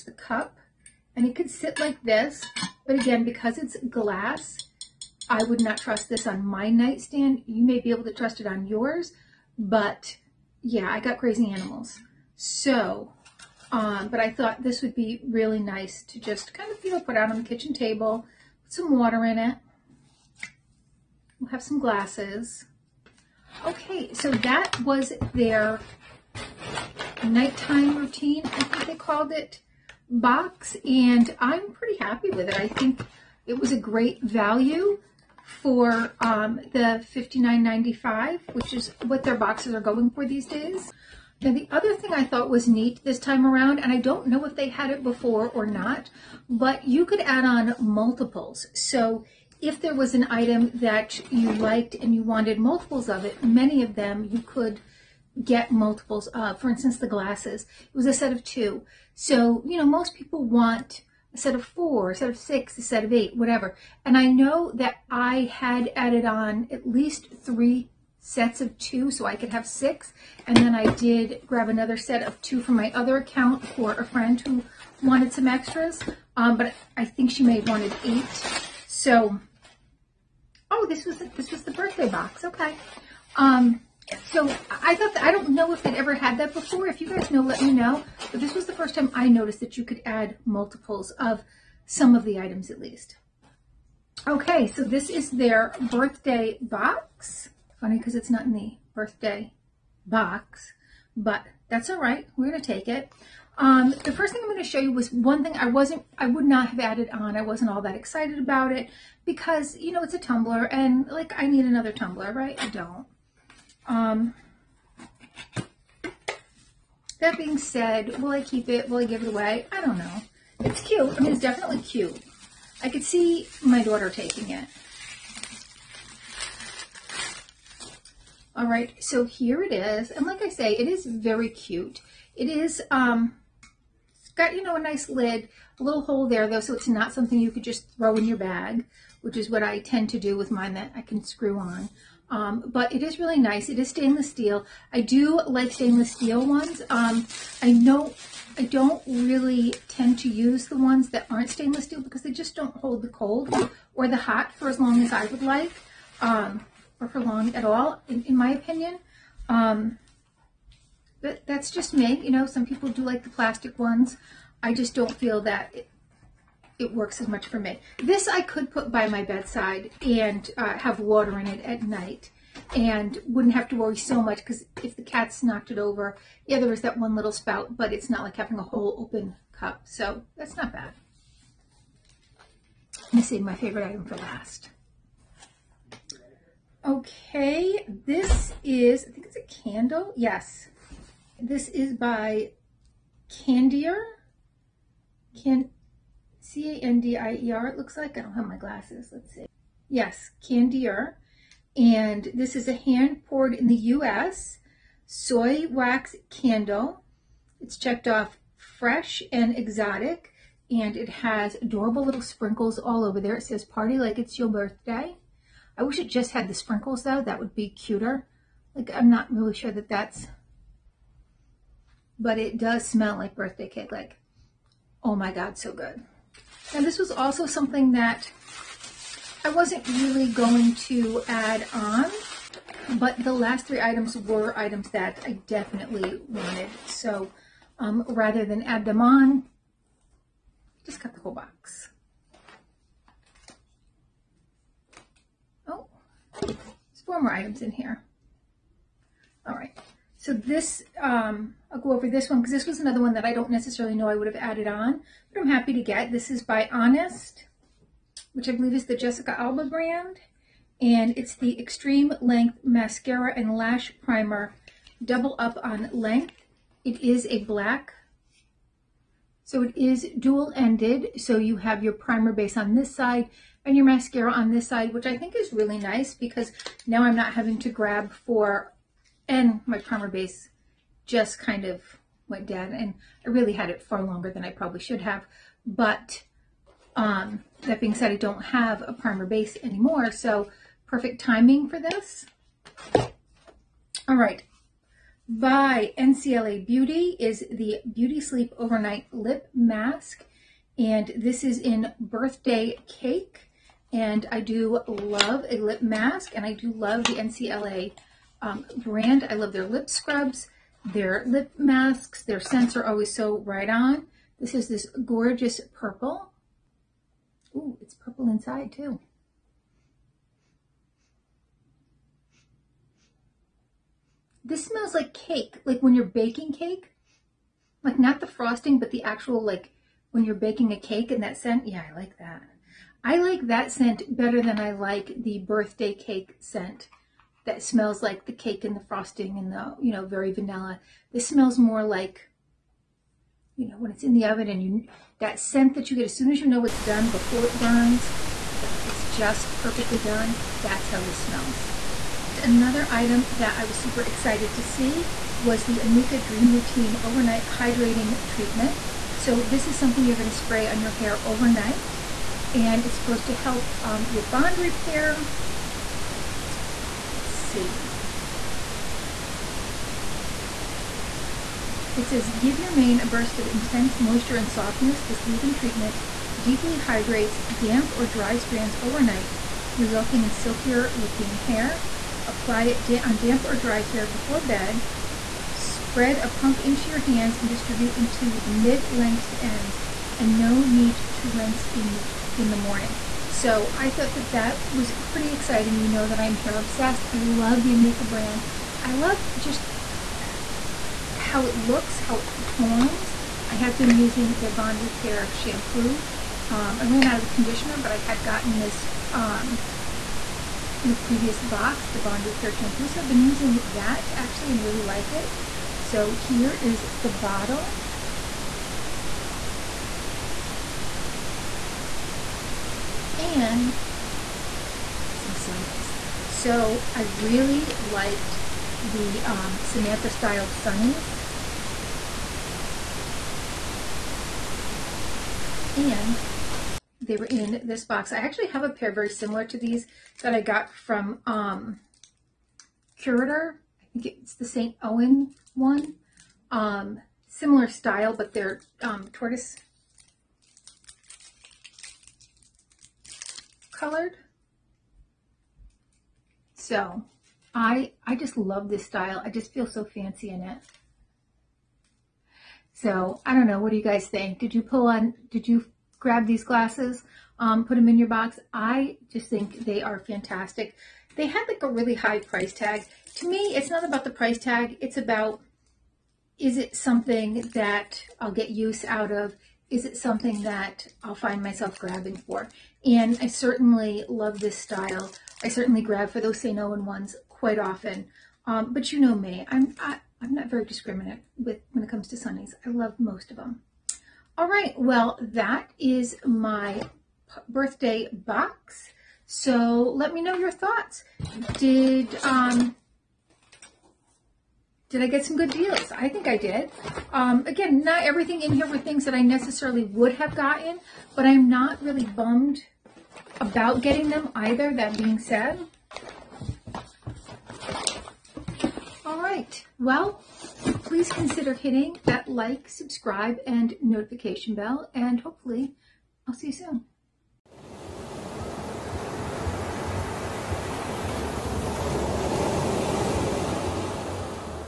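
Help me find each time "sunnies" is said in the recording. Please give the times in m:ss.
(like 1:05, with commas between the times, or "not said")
7:05, 7:10, 8:12.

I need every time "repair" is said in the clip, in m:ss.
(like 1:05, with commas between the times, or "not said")
6:04, 6:44, 6:52.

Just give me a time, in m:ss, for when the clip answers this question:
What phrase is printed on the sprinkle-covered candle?
3:33.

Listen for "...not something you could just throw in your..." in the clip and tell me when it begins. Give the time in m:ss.
2:16.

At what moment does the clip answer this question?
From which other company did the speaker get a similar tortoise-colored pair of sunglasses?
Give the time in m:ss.
7:22.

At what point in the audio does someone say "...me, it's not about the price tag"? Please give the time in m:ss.
7:53.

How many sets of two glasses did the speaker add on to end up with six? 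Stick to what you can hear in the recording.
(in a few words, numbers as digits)
3.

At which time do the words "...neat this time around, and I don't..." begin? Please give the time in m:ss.
0:42.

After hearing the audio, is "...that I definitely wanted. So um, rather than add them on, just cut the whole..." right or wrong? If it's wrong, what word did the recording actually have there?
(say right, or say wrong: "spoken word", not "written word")
right.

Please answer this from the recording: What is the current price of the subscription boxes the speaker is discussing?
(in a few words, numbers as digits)
$59.95.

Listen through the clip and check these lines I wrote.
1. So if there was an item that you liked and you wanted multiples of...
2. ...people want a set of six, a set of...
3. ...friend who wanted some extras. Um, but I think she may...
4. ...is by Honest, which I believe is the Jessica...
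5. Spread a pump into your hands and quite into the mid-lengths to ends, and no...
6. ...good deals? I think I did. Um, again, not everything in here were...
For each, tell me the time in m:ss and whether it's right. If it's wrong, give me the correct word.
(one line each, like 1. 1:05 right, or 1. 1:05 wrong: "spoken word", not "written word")
1. 0:48 right
2. 1:00 wrong: "four", not "six"
3. 1:14 right
4. 4:16 right
5. 6:25 wrong: "distribute", not "quite"
6. 8:25 right.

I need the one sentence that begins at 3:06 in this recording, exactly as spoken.
Okay, this is, I think it's a candle.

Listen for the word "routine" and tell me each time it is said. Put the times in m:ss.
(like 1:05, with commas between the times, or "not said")
0:27, 5:56.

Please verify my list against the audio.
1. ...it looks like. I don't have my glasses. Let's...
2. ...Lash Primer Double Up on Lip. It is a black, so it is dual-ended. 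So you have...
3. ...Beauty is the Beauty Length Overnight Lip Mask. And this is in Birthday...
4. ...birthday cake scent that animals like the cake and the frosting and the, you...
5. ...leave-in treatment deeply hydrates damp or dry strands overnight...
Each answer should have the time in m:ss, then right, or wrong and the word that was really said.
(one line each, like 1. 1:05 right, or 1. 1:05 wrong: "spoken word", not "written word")
1. 3:17 right
2. 4:23 wrong: "Length", not "Lip"
3. 4:56 wrong: "Sleep", not "Length"
4. 5:35 wrong: "smells", not "animals"
5. 6:15 right.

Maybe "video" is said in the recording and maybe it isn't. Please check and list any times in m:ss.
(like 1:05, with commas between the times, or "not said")
not said.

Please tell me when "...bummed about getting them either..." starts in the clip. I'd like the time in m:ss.
8:32.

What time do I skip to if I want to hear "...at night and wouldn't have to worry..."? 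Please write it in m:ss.
2:51.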